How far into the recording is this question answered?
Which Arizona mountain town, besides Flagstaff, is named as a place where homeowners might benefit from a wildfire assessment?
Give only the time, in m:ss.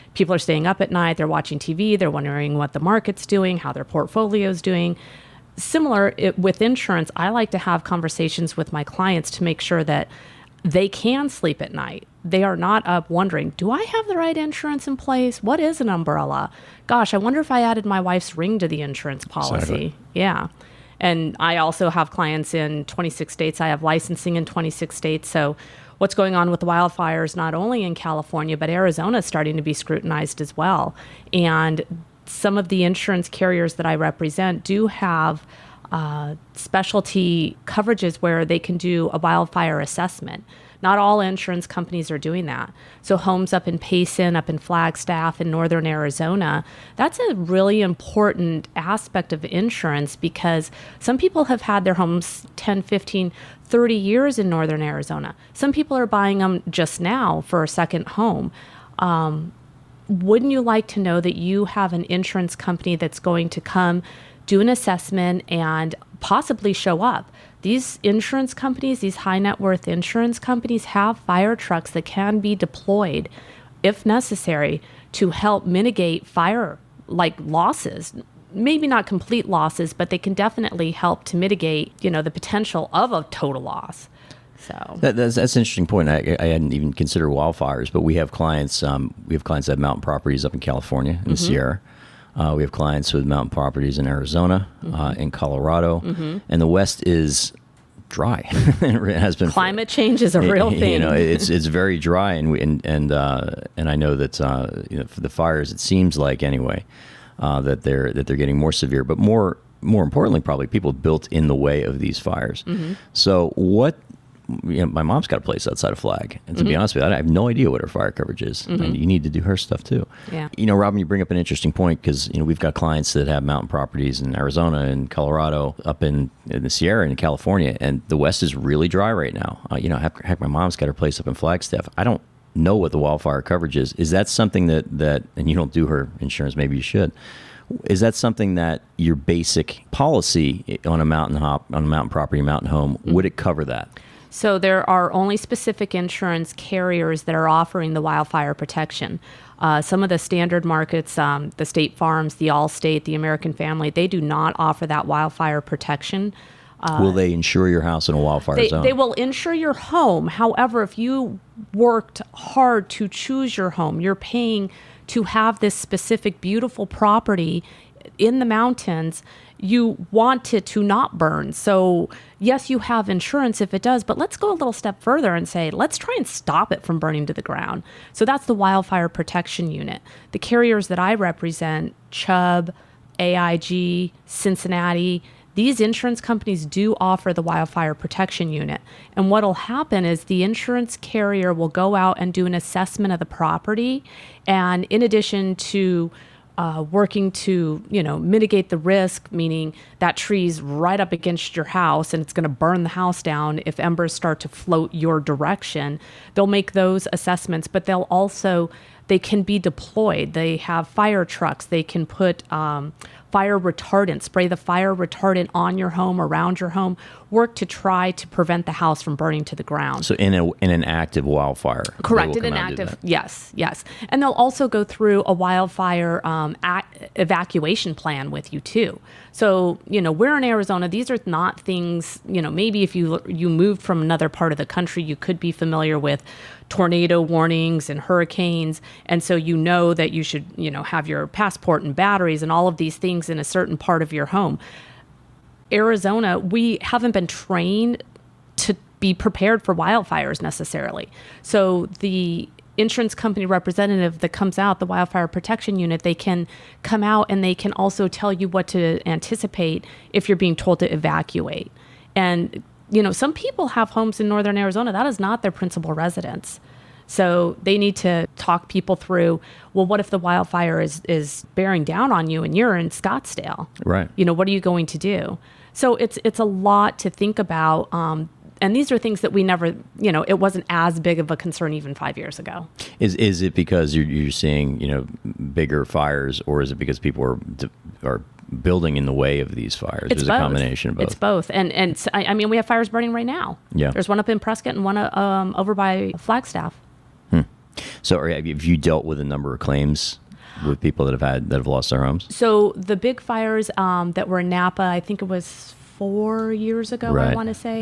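0:43.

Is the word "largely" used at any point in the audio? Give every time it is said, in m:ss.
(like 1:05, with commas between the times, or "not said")
not said.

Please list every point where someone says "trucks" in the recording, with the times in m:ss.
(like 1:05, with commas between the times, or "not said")
1:11, 3:31.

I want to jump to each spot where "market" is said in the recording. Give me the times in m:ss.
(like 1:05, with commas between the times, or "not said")
0:02, 2:30.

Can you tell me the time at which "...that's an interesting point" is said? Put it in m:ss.
1:25.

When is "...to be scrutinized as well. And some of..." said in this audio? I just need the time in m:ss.
0:29.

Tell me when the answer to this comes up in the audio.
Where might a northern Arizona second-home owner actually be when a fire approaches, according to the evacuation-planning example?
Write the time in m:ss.
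4:32.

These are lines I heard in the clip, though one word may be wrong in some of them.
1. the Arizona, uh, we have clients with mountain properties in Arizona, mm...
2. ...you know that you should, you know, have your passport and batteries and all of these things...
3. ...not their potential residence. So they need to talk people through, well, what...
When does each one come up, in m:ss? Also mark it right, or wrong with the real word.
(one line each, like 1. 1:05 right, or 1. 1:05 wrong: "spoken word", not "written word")
1. 1:31 wrong: "Sierra", not "Arizona"
2. 3:59 right
3. 4:25 wrong: "principal", not "potential".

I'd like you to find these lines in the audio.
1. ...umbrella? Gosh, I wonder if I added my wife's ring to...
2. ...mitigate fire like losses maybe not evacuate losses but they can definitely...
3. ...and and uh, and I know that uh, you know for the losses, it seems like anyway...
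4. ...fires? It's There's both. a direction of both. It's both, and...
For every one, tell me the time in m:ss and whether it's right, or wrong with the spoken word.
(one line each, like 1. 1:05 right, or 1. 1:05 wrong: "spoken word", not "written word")
1. 0:15 right
2. 1:15 wrong: "complete", not "evacuate"
3. 1:42 wrong: "fires", not "losses"
4. 4:49 wrong: "combination", not "direction".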